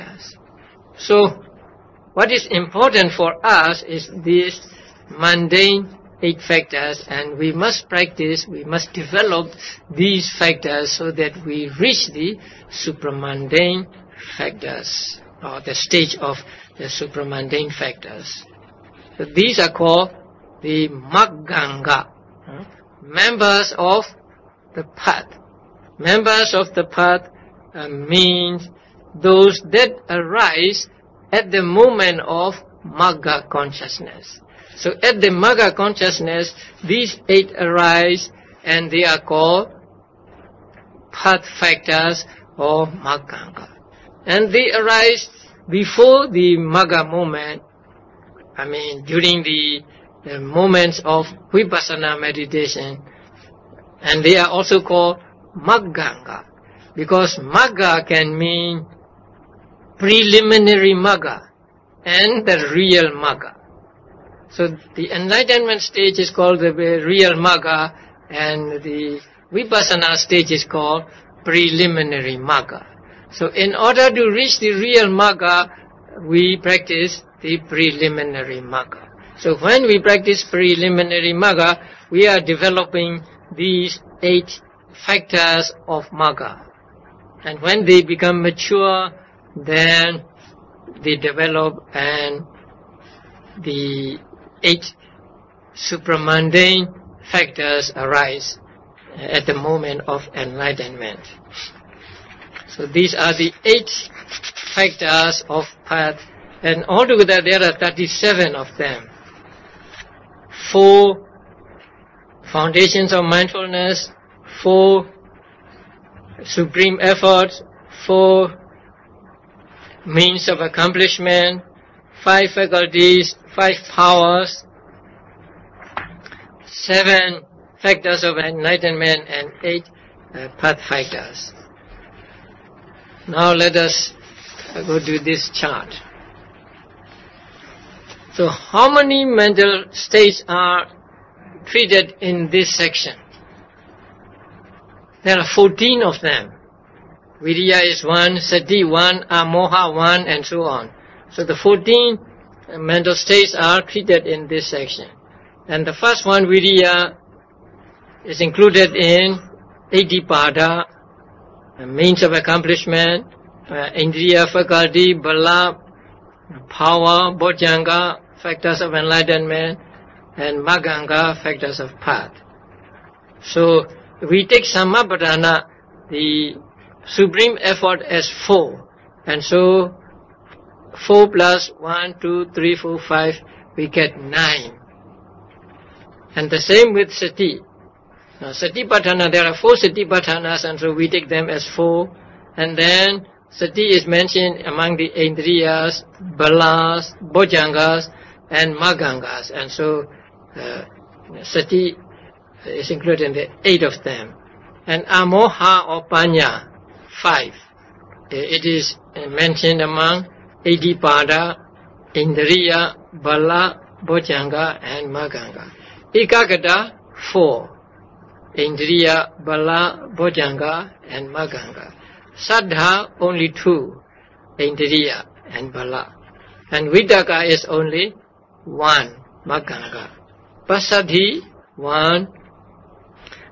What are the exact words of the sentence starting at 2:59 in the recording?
And so four plus one, two, three, four, five, we get nine.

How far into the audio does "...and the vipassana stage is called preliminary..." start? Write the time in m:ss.
1:08.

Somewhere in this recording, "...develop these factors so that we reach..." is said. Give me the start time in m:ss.
0:08.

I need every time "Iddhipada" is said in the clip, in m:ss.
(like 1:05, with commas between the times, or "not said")
2:39, 3:30.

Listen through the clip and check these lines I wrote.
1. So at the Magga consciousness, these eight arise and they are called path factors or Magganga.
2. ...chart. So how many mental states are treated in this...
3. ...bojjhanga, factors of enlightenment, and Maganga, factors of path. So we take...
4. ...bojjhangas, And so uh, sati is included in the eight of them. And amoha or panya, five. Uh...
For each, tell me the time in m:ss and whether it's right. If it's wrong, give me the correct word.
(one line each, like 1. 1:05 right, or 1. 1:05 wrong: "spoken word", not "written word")
1. 0:34 right
2. 2:15 right
3. 2:47 right
4. 3:18 wrong: "maggangas", not "bojjhangas".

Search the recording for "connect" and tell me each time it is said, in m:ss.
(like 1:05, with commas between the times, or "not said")
not said.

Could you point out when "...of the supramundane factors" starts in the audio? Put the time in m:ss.
0:16.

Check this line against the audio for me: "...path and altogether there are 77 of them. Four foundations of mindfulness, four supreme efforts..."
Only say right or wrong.
wrong.